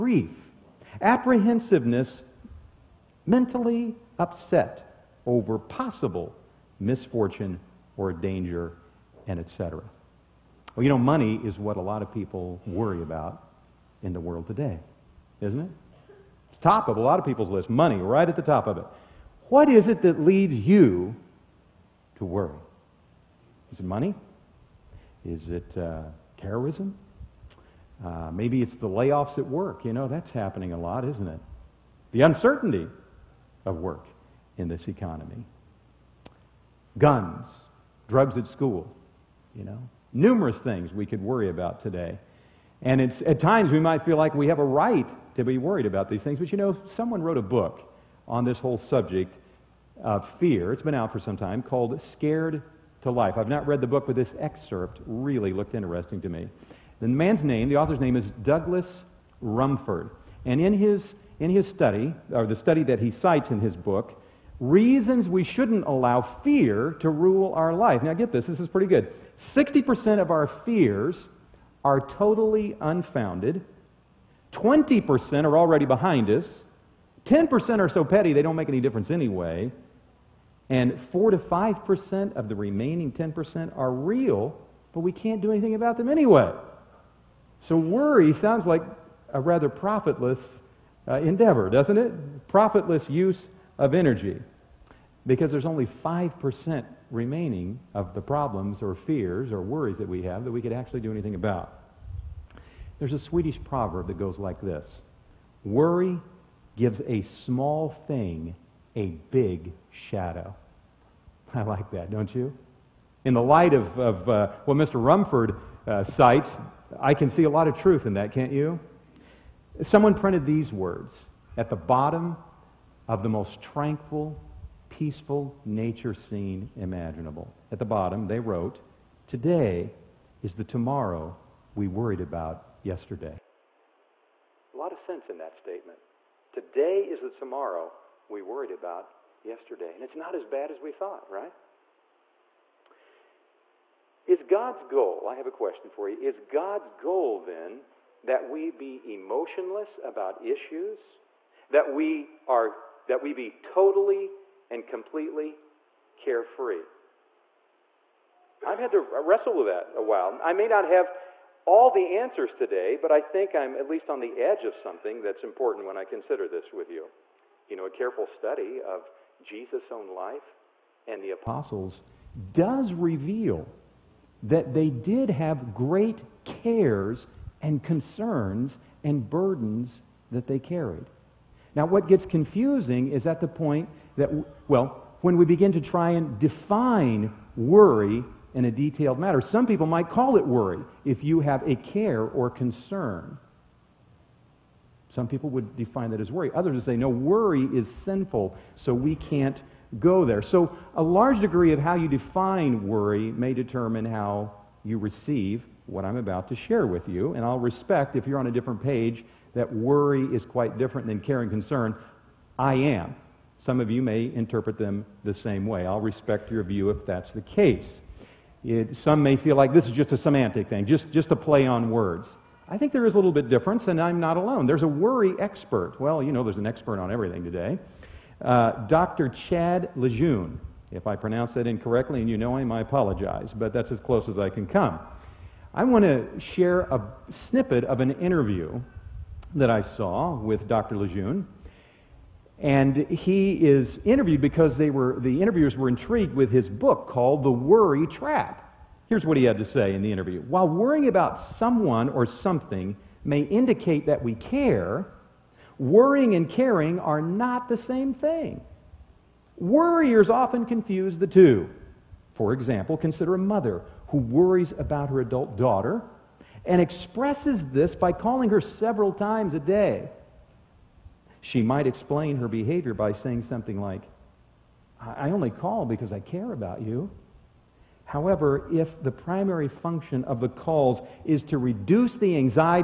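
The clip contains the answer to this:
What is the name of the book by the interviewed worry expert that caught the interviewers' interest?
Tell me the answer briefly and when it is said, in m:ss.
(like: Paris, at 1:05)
The Worry Trap, at 4:07.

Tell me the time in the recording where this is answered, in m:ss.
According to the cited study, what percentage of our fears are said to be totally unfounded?
1:09.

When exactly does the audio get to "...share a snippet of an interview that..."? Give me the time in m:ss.
3:56.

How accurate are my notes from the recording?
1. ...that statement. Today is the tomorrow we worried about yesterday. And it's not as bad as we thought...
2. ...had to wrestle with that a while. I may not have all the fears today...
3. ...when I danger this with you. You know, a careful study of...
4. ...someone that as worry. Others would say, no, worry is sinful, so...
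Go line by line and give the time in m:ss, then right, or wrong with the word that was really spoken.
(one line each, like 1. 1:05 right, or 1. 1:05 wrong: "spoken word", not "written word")
1. 2:15 right
2. 2:38 wrong: "answers", not "fears"
3. 2:45 wrong: "consider", not "danger"
4. 3:15 wrong: "define", not "someone".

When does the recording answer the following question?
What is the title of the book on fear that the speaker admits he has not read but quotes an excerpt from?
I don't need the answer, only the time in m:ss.
0:52.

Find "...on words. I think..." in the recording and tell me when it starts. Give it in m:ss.
3:41.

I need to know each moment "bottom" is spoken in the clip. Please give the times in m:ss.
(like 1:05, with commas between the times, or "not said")
2:01, 2:07.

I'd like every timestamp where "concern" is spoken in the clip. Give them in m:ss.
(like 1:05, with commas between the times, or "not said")
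2:57, 3:12, 3:31.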